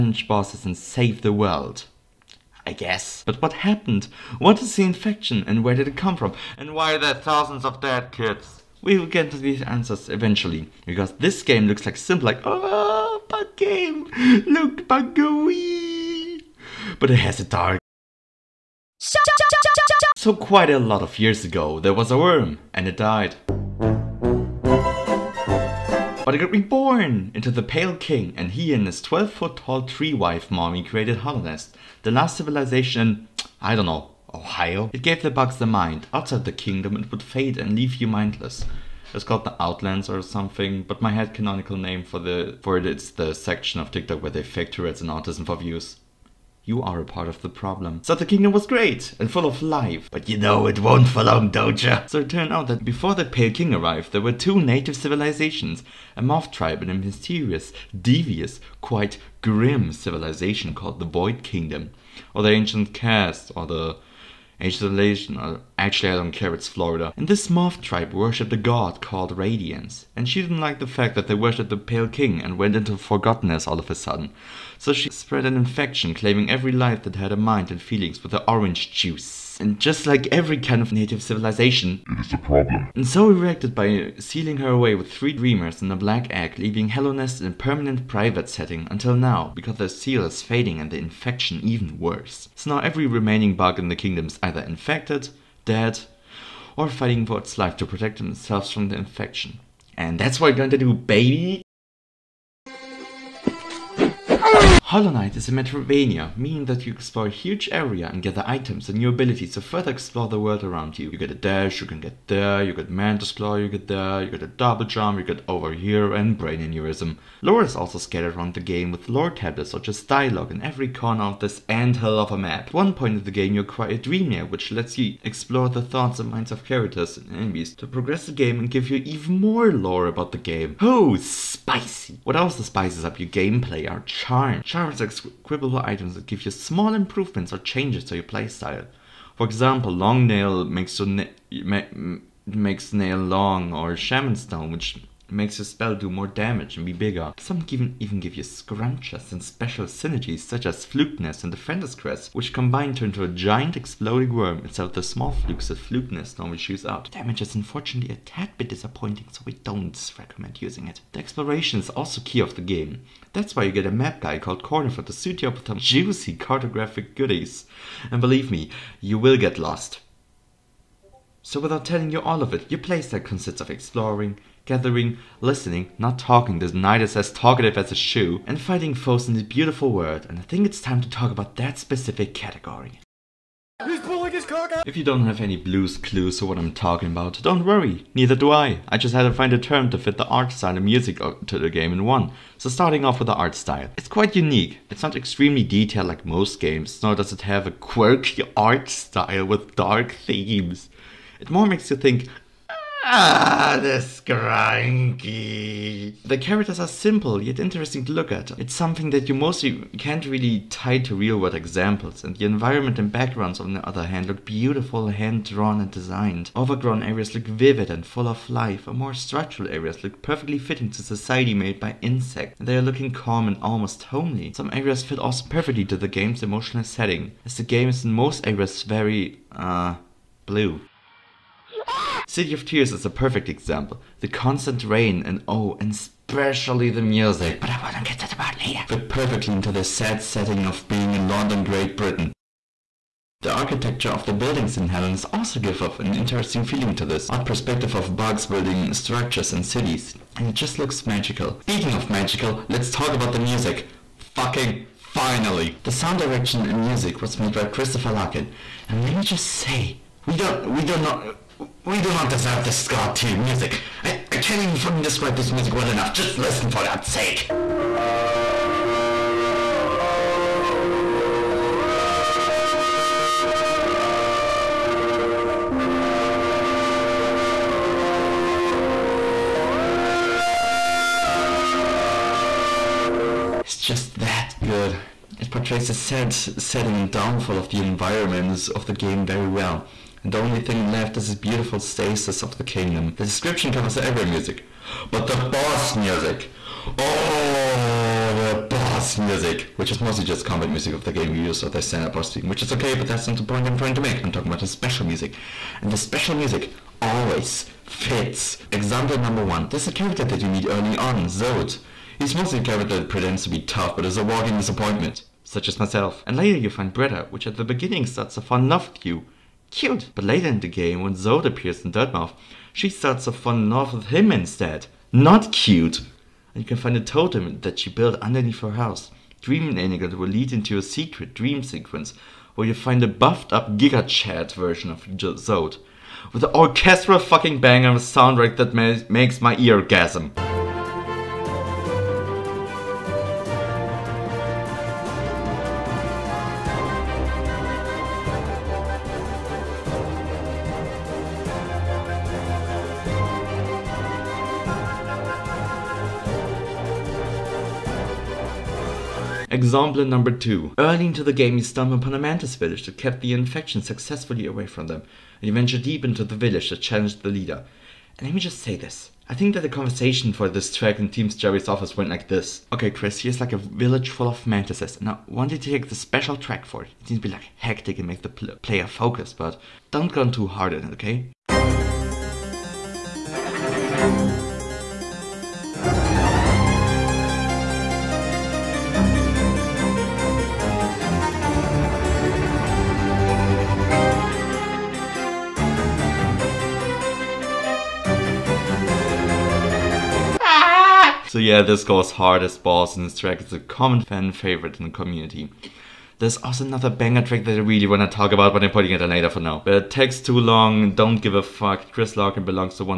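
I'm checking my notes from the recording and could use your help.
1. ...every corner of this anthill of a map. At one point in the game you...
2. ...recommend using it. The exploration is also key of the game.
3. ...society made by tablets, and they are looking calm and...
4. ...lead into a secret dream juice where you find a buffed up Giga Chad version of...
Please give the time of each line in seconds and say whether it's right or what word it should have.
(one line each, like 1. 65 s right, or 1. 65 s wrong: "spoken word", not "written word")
1. 120 s right
2. 160 s right
3. 221 s wrong: "insects", not "tablets"
4. 330 s wrong: "sequence", not "juice".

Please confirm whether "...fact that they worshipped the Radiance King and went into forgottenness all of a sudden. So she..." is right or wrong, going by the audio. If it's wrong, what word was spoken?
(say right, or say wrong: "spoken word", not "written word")
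wrong: "Pale", not "Radiance".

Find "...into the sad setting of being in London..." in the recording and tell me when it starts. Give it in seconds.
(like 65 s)
239 s.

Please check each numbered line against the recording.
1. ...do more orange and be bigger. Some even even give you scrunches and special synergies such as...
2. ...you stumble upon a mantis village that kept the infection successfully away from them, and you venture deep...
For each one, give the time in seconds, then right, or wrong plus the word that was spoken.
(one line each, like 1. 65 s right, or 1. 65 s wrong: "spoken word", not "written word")
1. 145 s wrong: "damage", not "orange"
2. 361 s right.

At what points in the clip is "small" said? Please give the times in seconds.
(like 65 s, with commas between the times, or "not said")
136 s, 155 s.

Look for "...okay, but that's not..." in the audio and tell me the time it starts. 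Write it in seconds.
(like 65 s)
302 s.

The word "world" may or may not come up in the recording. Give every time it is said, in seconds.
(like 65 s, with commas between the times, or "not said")
1 s, 110 s, 179 s, 211 s.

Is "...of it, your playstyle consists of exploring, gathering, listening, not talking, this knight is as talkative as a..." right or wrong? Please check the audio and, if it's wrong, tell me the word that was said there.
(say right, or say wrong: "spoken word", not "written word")
right.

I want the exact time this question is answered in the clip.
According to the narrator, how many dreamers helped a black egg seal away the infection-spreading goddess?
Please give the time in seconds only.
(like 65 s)
85 s.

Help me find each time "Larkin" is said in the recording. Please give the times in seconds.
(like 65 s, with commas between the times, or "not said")
258 s, 412 s.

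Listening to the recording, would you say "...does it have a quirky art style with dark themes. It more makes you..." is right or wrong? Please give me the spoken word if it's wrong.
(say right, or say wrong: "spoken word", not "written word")
right.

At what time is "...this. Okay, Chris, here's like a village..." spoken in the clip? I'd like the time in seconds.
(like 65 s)
372 s.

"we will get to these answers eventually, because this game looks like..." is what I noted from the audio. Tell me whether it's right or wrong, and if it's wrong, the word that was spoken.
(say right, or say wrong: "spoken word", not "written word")
right.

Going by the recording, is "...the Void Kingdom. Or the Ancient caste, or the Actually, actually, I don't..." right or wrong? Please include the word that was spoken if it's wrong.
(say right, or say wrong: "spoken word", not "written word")
right.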